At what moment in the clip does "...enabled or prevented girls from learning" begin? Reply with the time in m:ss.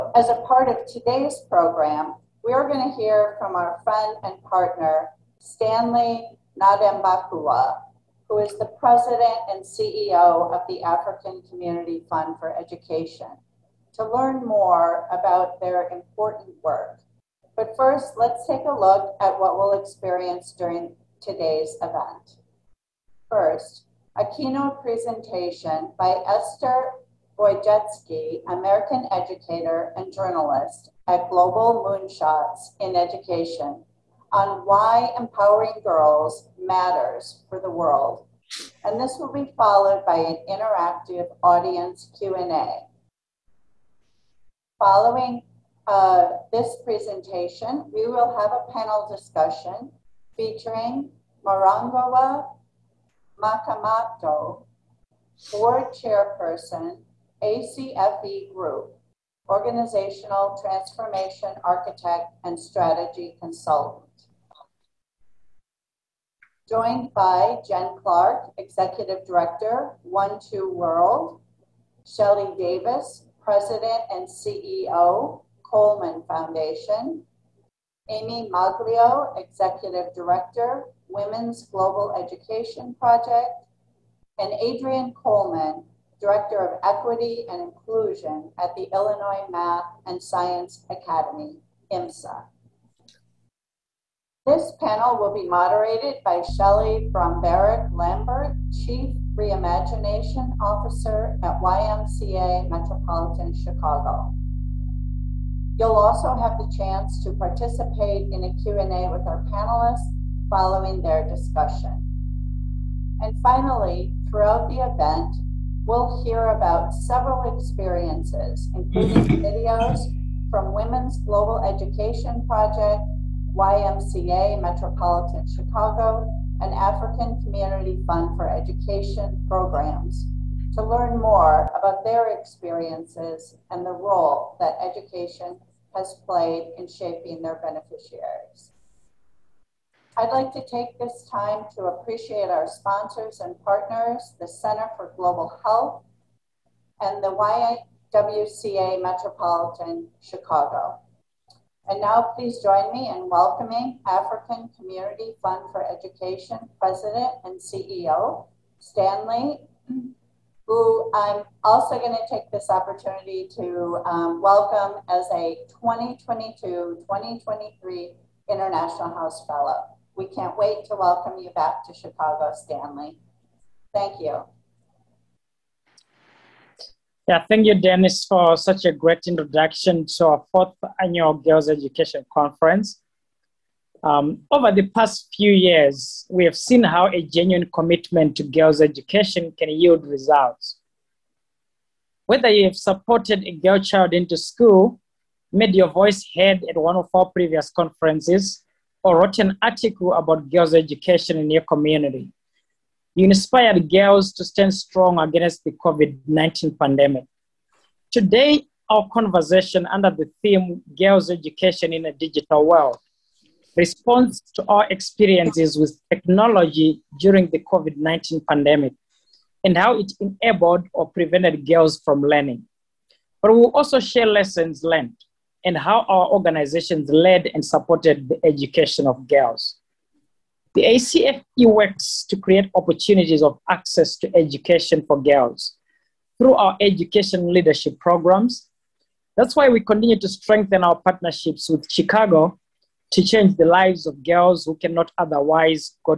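3:40.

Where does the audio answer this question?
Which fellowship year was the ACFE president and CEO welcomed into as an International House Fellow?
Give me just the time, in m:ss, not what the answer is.
2:45.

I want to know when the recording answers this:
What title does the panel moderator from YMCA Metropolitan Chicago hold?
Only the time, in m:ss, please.
1:38.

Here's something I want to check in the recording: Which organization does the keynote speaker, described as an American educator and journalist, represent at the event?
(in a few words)
Global Moonshots in Education.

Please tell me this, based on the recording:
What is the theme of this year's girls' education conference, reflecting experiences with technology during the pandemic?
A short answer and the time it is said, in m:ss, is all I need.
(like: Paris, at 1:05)
Girls' Education in a Digital World, at 3:30.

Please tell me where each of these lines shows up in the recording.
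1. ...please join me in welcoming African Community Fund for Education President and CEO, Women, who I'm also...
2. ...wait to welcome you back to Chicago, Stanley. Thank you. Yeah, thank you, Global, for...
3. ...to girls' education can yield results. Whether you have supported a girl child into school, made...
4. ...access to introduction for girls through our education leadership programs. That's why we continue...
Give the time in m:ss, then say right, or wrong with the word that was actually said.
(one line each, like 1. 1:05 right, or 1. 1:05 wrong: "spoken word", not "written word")
1. 2:32 wrong: "Stanley", not "Women"
2. 2:50 wrong: "Dennis", not "Global"
3. 3:08 right
4. 3:53 wrong: "education", not "introduction".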